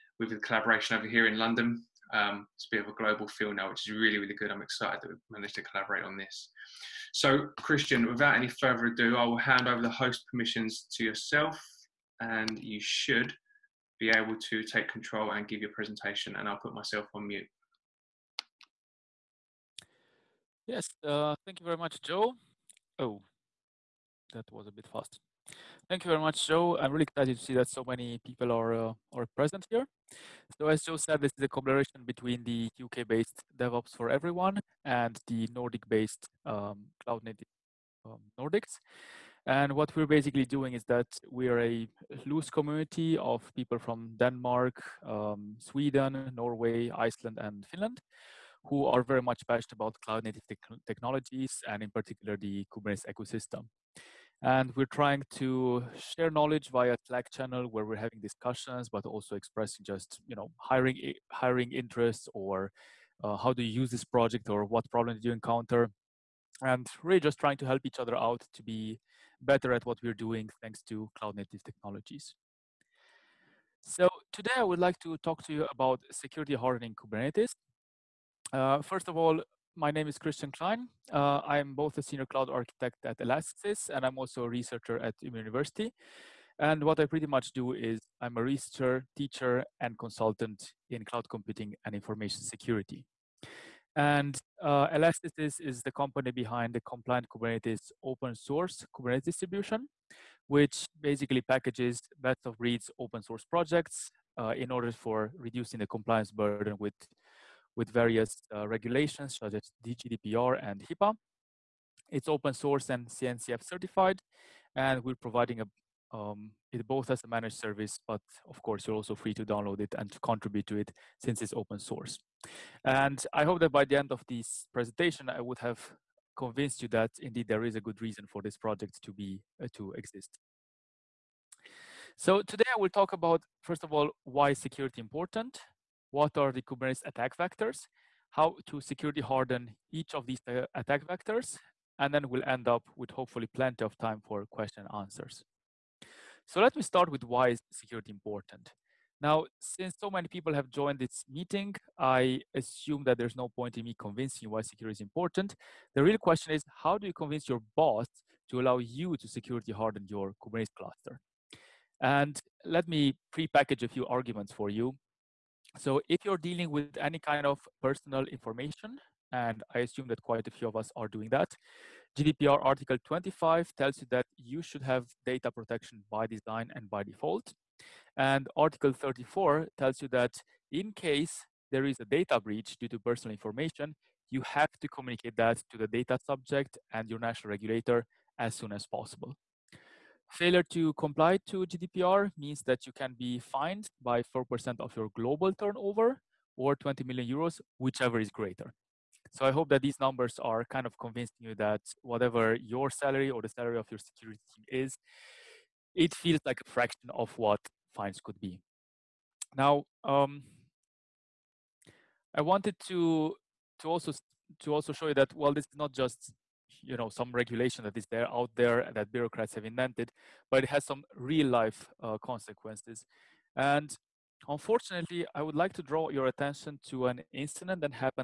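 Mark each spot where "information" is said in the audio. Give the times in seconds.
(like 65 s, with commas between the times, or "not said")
91 s, 168 s, 183 s.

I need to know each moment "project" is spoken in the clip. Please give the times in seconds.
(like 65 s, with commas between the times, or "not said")
64 s, 103 s, 128 s.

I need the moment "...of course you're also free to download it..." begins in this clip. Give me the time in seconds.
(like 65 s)
118 s.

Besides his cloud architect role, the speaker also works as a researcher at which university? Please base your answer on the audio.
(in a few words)
Umeå University.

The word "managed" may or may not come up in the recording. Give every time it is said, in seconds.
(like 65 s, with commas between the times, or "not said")
5 s, 117 s.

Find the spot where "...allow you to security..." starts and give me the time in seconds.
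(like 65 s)
158 s.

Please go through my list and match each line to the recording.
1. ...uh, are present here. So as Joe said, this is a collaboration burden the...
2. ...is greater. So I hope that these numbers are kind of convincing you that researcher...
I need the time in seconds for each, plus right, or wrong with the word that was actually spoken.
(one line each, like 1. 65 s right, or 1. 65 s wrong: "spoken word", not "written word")
1. 28 s wrong: "between", not "burden"
2. 198 s wrong: "whatever", not "researcher".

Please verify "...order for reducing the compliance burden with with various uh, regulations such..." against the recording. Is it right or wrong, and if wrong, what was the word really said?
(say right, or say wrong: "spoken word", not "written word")
right.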